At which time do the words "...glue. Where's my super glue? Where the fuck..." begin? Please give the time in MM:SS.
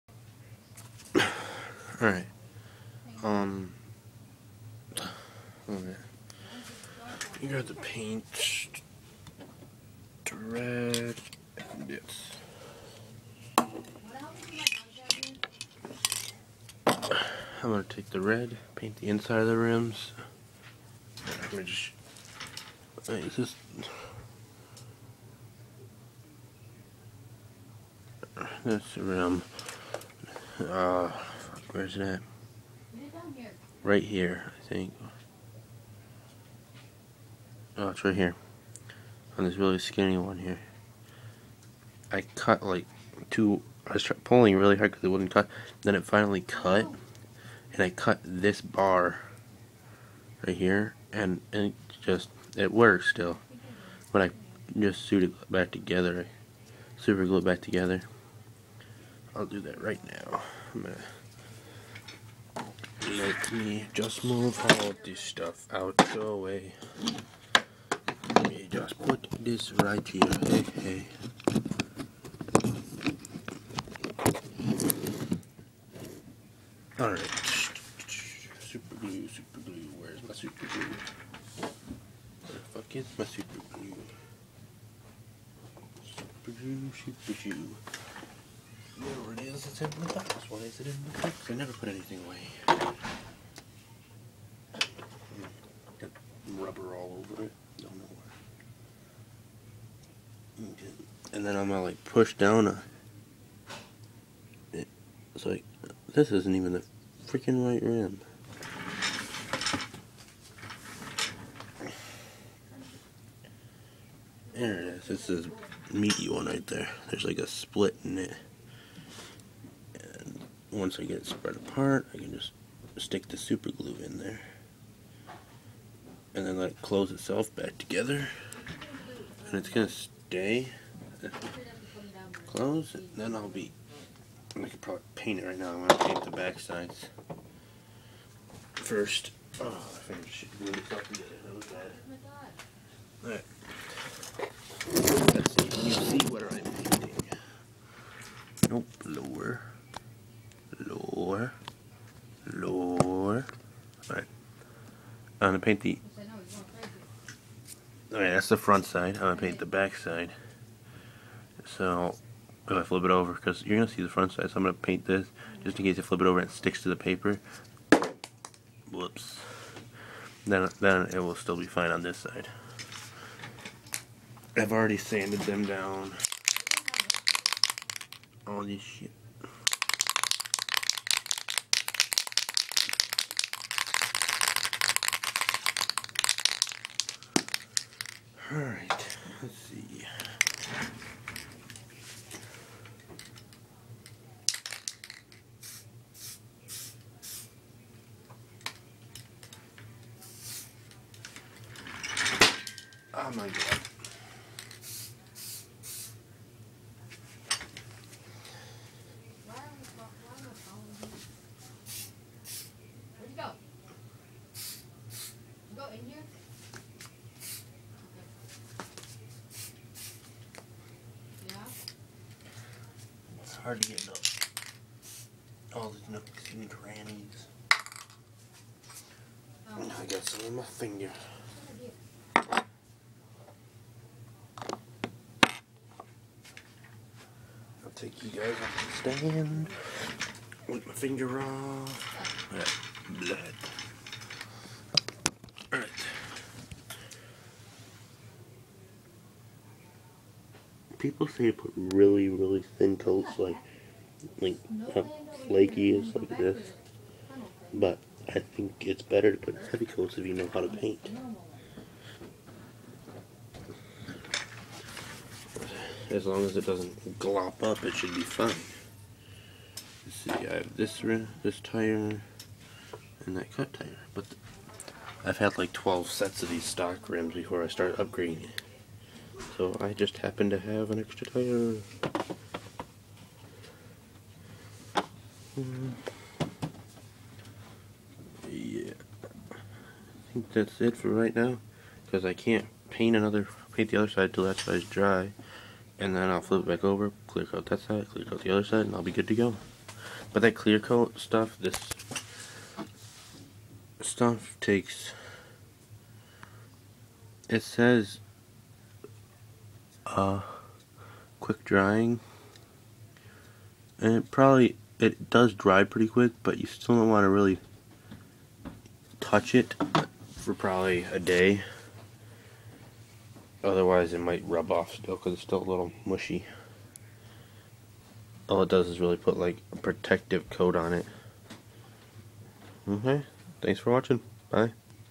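01:19.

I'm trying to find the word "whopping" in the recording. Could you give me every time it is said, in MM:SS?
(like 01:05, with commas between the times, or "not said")
not said.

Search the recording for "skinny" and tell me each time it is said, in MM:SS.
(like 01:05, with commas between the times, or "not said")
00:39.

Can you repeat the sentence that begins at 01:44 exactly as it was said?
It, it's like this isn't even the freaking right rim.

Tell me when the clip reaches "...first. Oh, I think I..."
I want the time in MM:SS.
02:18.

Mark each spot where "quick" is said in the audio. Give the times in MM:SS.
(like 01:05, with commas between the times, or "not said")
05:11, 05:16.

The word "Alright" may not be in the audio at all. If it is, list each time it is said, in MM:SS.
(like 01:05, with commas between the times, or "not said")
01:16, 02:23, 02:38.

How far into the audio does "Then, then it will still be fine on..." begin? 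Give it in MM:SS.
02:50.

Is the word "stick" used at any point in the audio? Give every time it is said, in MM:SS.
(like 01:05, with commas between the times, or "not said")
02:02, 02:46.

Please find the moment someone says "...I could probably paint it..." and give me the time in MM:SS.
02:14.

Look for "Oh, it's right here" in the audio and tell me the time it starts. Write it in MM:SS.
00:37.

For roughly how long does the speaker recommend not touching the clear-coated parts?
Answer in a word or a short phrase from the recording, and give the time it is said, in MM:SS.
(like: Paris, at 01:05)
A day, at 05:21.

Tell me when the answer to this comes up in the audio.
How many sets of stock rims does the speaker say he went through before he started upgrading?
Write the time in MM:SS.
04:35.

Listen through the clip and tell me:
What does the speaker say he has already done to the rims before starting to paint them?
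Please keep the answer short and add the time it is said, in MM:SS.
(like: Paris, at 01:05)
Sanded them, at 02:54.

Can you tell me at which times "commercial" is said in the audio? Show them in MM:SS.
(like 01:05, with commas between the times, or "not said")
not said.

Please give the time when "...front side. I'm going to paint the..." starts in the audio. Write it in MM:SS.
02:38.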